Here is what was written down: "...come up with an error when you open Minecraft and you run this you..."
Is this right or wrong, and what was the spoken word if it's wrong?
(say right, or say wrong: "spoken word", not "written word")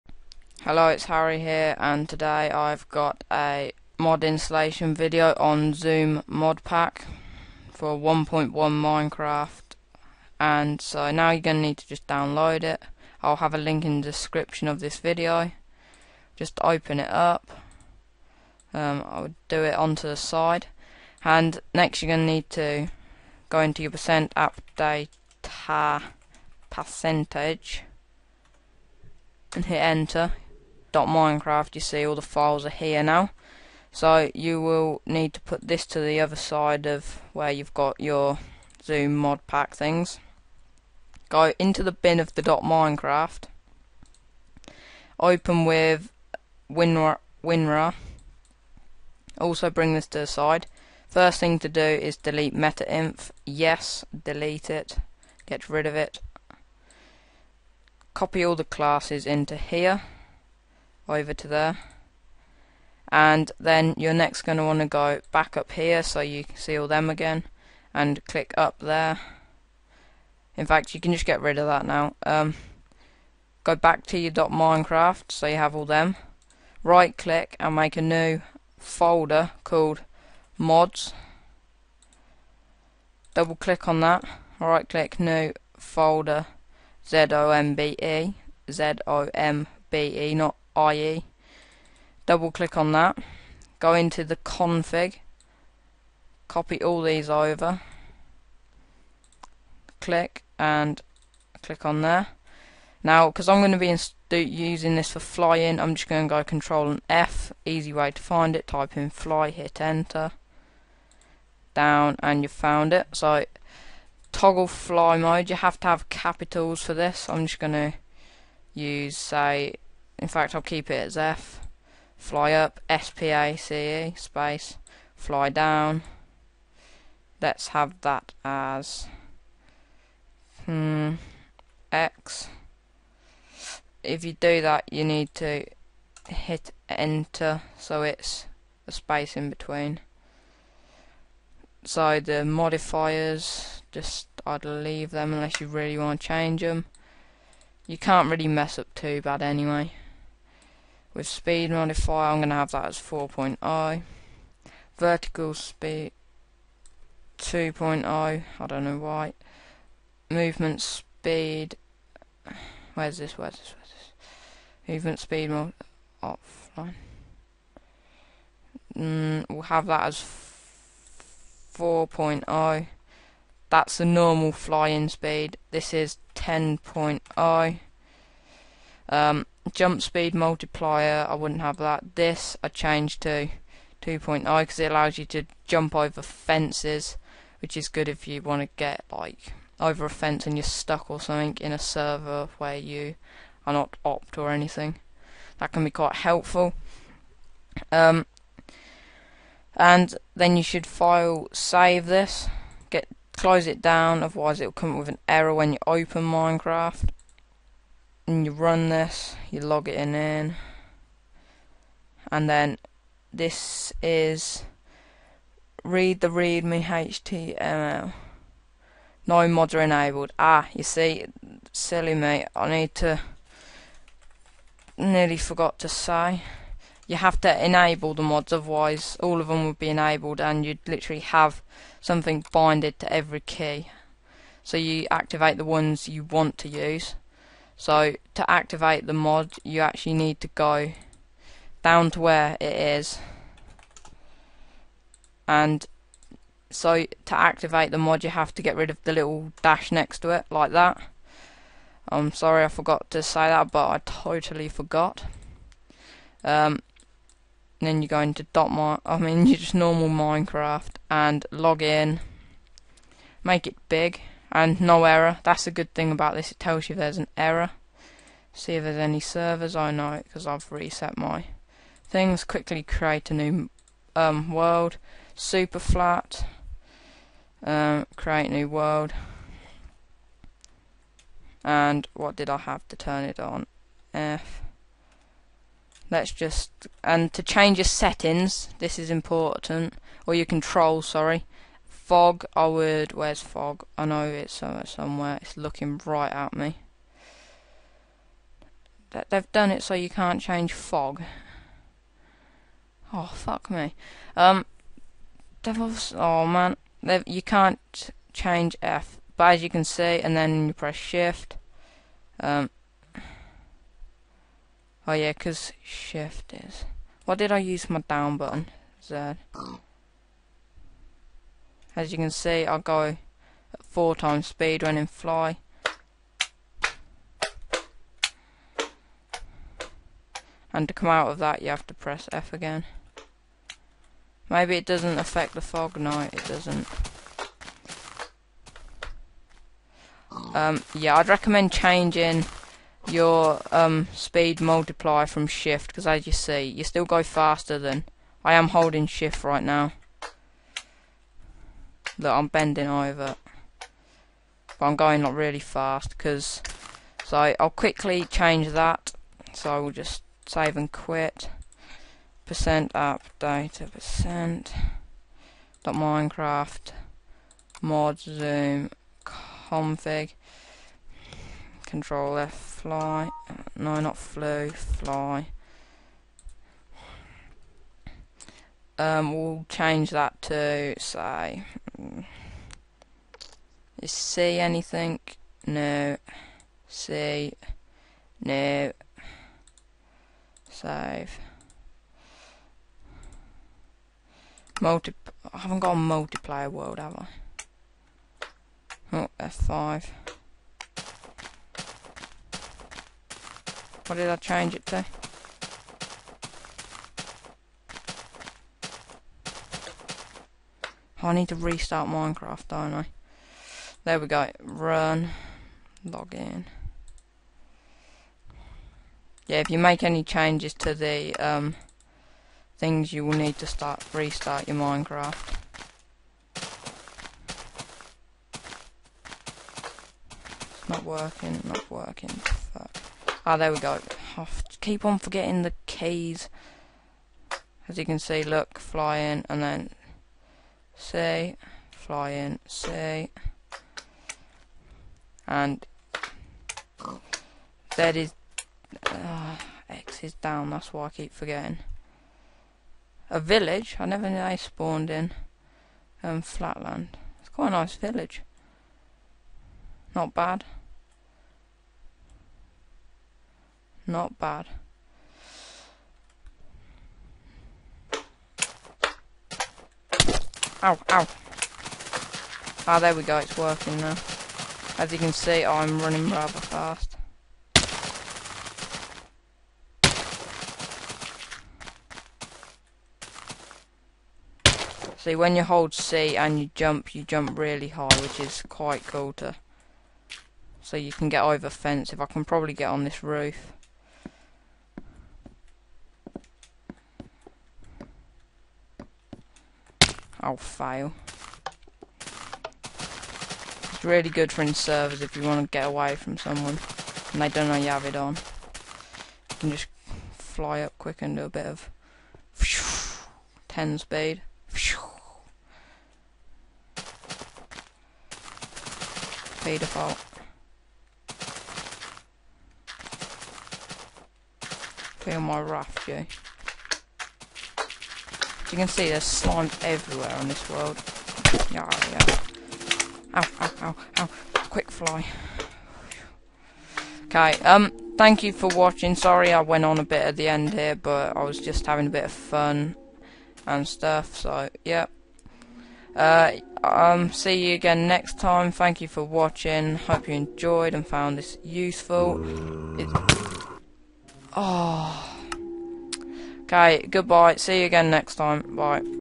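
right.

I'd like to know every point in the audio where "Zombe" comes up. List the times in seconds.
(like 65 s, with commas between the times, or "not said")
5 s, 38 s, 368 s.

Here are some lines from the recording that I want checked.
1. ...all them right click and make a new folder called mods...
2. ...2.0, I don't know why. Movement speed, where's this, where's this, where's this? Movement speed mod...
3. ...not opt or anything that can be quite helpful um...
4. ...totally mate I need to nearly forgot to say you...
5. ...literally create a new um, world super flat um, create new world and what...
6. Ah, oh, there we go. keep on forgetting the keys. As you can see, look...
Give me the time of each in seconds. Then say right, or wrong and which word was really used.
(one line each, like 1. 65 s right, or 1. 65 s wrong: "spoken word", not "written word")
1. 75 s right
2. 157 s right
3. 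193 s right
4. 221 s wrong: "silly", not "totally"
5. 272 s wrong: "quickly", not "literally"
6. 433 s right.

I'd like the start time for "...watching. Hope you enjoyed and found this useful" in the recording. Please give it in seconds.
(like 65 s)
549 s.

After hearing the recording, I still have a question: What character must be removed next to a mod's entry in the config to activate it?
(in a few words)
little dash.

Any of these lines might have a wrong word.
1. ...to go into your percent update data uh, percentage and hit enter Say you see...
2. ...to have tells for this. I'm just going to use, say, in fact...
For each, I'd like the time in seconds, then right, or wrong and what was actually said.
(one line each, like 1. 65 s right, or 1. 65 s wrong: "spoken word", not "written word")
1. 22 s wrong: "Minecraft", not "Say"
2. 115 s wrong: "capitals", not "tells".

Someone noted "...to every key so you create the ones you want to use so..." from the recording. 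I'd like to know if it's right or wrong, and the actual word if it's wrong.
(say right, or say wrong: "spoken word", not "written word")
wrong: "activate", not "create".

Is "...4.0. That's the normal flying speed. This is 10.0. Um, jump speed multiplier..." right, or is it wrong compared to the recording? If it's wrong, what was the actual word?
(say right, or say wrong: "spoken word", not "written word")
right.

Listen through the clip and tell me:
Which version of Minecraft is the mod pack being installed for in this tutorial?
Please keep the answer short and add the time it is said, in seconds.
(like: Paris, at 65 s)
1.1, at 7 s.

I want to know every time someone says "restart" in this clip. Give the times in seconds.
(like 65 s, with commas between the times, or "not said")
411 s, 424 s.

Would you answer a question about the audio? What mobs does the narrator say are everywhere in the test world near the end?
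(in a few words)
slime.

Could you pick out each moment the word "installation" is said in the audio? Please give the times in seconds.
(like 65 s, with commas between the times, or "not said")
4 s.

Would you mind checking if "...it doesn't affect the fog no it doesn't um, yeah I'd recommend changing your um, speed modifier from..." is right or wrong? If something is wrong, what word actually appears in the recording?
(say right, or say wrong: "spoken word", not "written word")
wrong: "multiplier", not "modifier".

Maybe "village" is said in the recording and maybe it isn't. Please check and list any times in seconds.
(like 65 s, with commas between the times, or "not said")
453 s, 457 s.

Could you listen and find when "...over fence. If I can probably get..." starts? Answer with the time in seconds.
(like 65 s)
491 s.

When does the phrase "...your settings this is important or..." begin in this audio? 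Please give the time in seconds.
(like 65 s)
287 s.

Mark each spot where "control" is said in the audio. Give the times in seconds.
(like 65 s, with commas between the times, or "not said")
106 s, 290 s, 371 s.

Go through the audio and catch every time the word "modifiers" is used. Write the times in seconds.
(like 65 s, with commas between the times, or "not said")
142 s, 151 s.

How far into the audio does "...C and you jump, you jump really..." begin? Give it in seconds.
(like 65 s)
485 s.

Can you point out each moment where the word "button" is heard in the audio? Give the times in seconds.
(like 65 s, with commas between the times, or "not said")
318 s.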